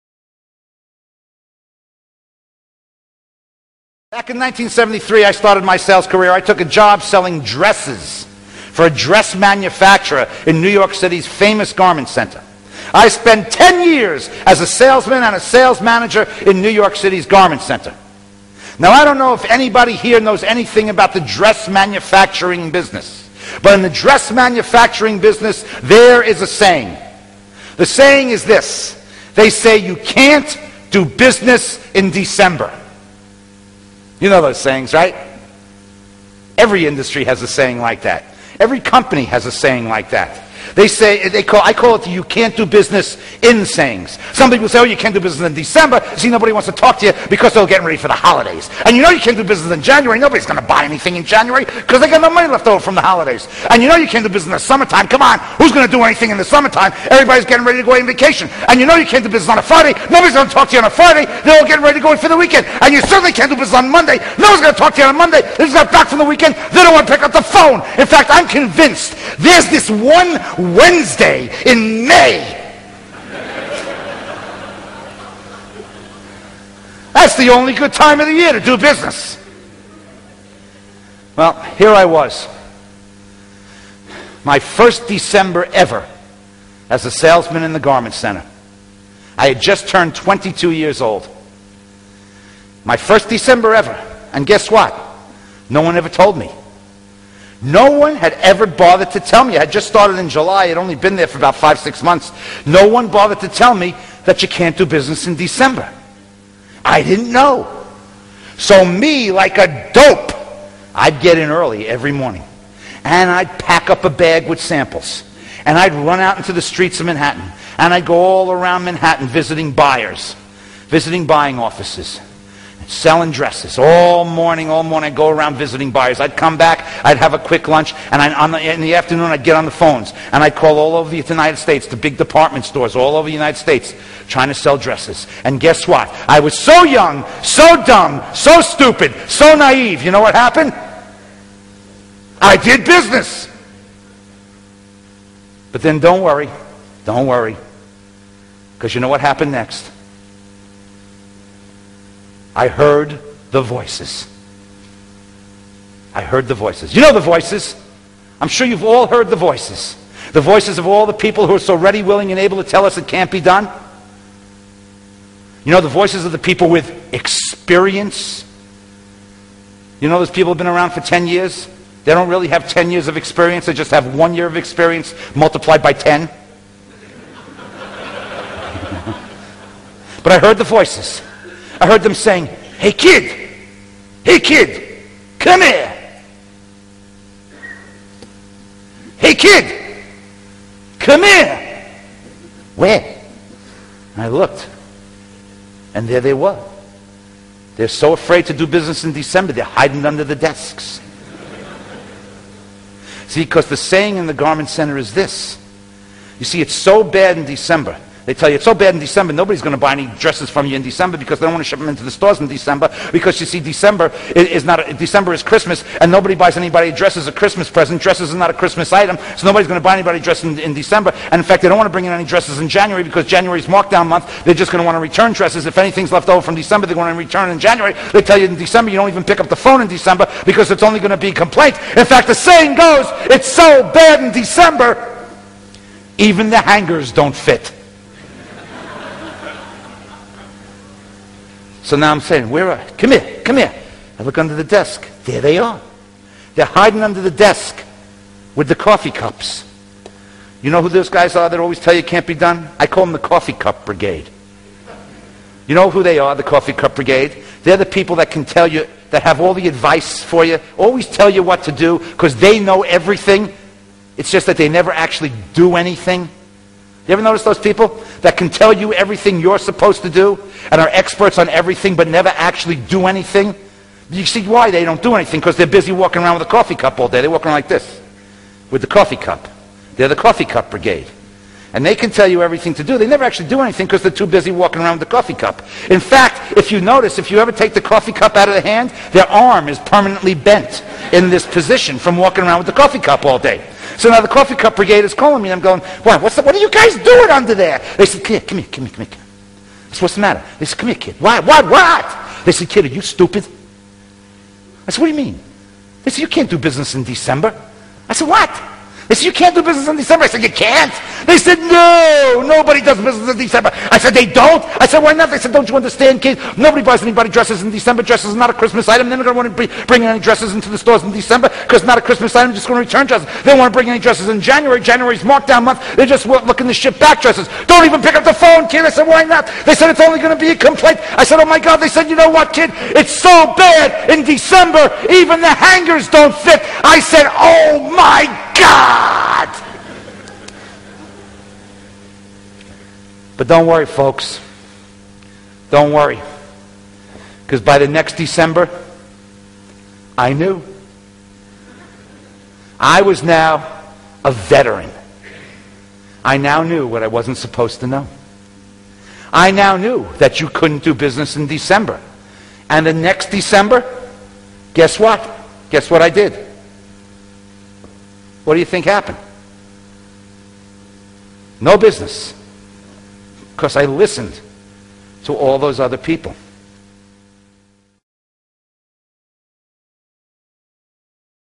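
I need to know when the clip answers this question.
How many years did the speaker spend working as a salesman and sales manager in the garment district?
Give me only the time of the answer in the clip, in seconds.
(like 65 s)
13 s.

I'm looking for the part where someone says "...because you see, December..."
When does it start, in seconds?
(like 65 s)
213 s.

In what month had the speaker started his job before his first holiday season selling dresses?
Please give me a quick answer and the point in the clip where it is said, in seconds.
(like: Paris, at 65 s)
July, at 100 s.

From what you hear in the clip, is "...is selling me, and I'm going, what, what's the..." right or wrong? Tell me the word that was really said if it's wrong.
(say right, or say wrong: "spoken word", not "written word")
wrong: "calling", not "selling".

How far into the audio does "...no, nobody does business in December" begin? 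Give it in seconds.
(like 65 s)
311 s.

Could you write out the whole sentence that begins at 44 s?
Some people say, oh, you can't do business in December.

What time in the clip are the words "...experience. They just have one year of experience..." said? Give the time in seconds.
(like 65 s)
173 s.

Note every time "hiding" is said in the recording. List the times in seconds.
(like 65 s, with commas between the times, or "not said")
199 s, 246 s.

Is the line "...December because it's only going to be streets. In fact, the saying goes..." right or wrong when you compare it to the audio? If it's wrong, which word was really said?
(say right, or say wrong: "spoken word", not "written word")
wrong: "complaints", not "streets".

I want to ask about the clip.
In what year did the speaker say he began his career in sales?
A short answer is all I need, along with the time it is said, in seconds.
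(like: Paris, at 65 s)
1973, at 4 s.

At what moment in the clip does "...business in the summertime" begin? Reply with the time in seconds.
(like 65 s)
54 s.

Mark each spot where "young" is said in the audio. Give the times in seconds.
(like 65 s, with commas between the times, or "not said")
136 s.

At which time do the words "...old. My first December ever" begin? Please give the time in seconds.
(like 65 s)
91 s.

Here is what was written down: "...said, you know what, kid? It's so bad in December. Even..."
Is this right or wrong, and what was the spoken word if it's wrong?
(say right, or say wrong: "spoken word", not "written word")
right.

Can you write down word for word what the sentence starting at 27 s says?
The saying is this they say you can't do business in December.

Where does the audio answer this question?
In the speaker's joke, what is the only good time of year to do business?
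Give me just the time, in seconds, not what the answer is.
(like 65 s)
69 s.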